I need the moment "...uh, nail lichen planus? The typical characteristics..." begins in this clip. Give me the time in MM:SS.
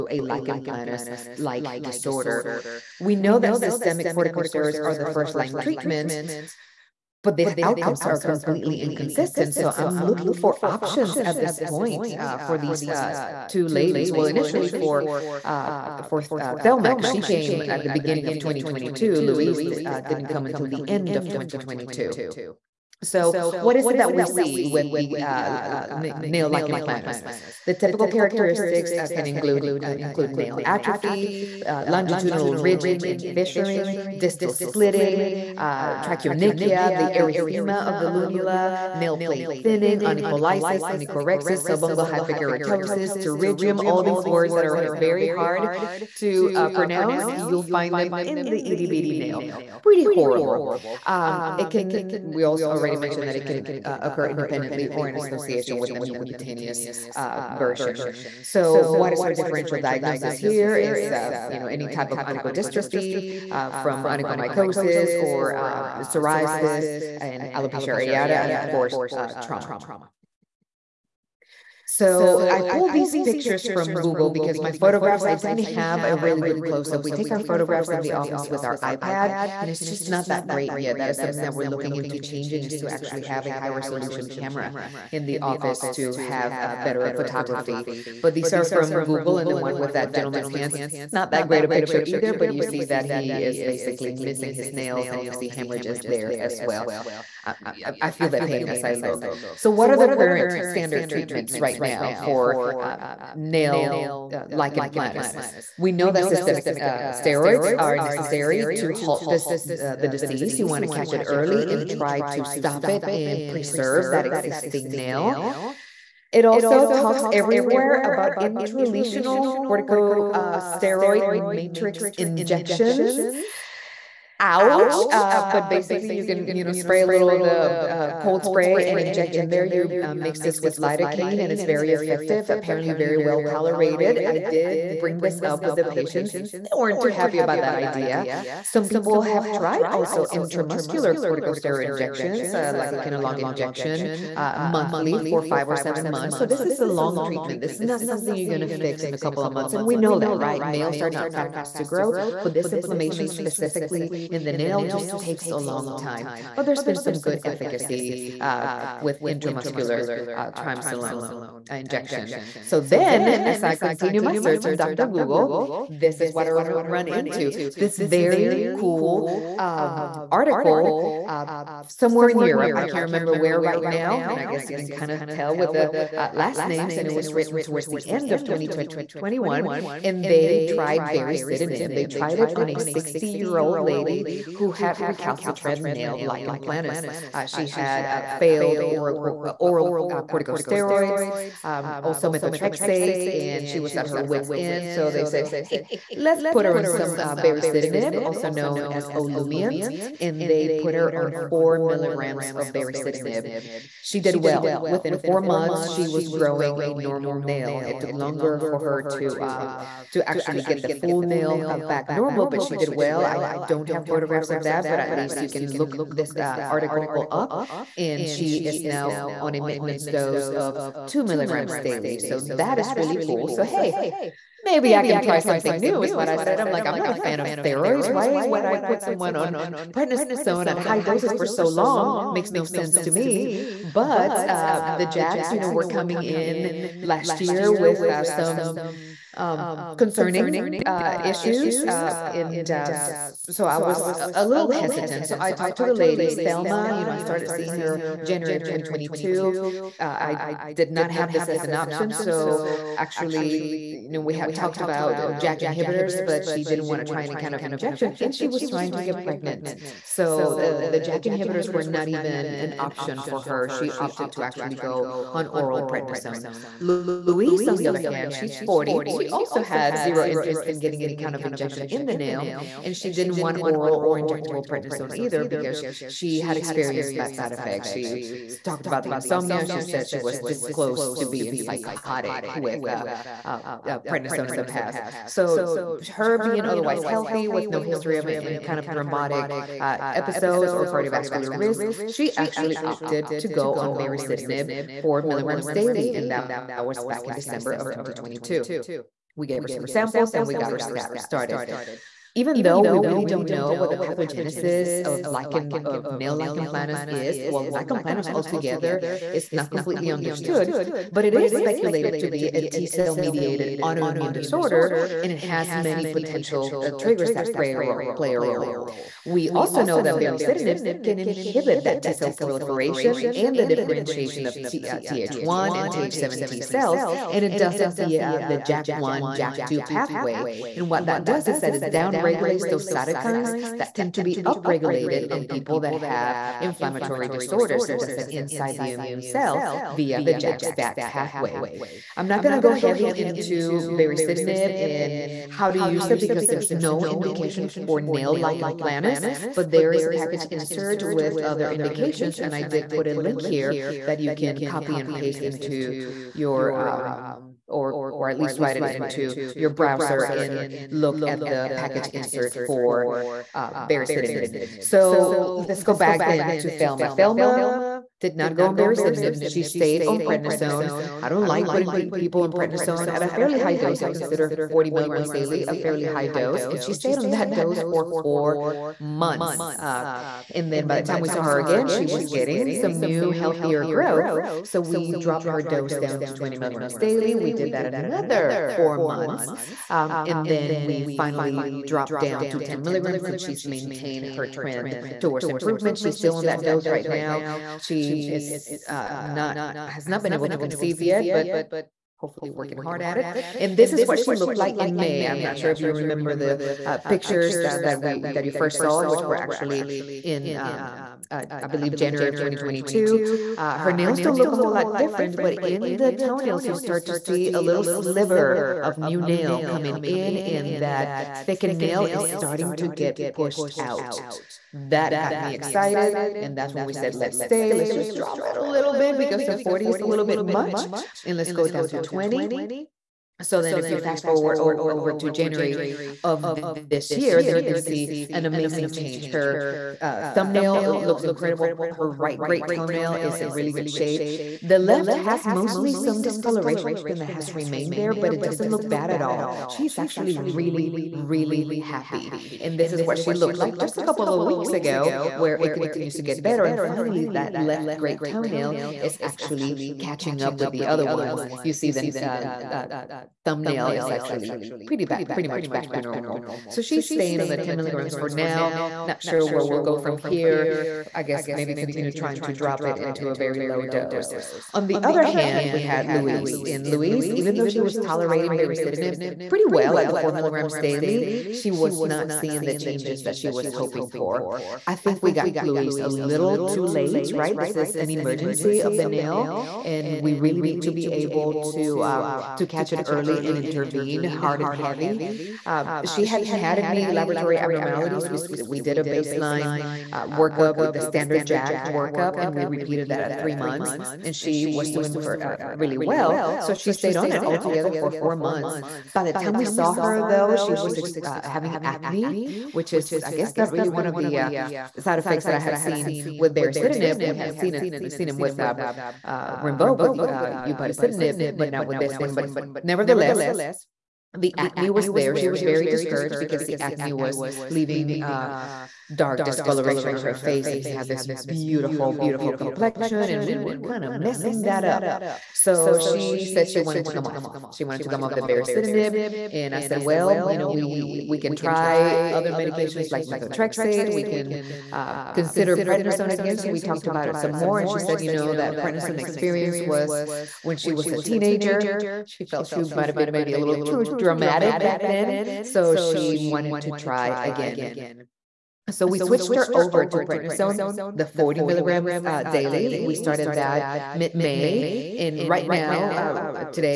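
00:25.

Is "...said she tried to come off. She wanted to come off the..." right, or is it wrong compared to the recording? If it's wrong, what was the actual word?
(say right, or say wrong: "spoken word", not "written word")
wrong: "wanted", not "tried".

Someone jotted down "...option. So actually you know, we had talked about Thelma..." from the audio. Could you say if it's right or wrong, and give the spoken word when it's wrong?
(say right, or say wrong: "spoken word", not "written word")
wrong: "JAK", not "Thelma".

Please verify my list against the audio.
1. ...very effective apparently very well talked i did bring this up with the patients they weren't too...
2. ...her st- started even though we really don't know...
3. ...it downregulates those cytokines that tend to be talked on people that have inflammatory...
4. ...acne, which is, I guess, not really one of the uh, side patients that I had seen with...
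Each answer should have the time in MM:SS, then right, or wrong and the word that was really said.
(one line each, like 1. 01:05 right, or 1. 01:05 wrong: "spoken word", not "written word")
1. 02:11 wrong: "tolerated", not "talked"
2. 05:00 right
3. 05:31 wrong: "upregulated", not "talked"
4. 08:31 wrong: "effects", not "patients".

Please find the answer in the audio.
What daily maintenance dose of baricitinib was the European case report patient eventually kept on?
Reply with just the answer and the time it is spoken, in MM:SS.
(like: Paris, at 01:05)
2 milligrams, at 03:41.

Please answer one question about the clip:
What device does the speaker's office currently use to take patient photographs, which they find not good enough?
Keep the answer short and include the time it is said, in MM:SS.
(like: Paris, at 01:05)
iPad, at 01:18.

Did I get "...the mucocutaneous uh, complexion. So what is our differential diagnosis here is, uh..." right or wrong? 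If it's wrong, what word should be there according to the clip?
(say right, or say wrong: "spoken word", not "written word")
wrong: "version", not "complexion".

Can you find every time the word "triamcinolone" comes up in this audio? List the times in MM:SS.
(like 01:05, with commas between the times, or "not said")
02:40.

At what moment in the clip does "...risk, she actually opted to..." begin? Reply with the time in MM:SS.
04:51.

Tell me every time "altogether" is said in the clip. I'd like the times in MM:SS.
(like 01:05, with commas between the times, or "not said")
05:08, 08:27.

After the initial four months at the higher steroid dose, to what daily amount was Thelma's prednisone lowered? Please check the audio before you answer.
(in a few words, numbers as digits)
20 milligrams.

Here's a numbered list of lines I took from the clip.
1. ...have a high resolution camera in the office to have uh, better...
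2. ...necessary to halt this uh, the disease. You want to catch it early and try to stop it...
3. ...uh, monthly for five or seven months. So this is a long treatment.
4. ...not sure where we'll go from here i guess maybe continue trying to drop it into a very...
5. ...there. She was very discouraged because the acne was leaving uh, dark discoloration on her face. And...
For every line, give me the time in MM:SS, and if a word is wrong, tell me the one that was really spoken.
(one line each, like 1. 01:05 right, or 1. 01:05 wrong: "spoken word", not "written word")
1. 01:23 right
2. 01:47 right
3. 02:24 right
4. 07:49 right
5. 08:45 right.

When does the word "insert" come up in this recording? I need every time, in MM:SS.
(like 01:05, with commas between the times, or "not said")
05:50, 06:02.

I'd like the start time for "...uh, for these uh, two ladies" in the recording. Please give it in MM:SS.
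00:12.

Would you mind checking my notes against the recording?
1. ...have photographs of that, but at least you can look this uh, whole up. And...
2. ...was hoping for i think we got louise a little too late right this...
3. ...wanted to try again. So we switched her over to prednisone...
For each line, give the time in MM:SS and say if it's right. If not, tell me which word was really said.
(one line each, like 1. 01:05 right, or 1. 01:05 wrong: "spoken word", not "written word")
1. 03:33 wrong: "article", not "whole"
2. 08:03 right
3. 09:16 right.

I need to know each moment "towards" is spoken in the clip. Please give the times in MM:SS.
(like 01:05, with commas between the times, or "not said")
02:57, 06:35.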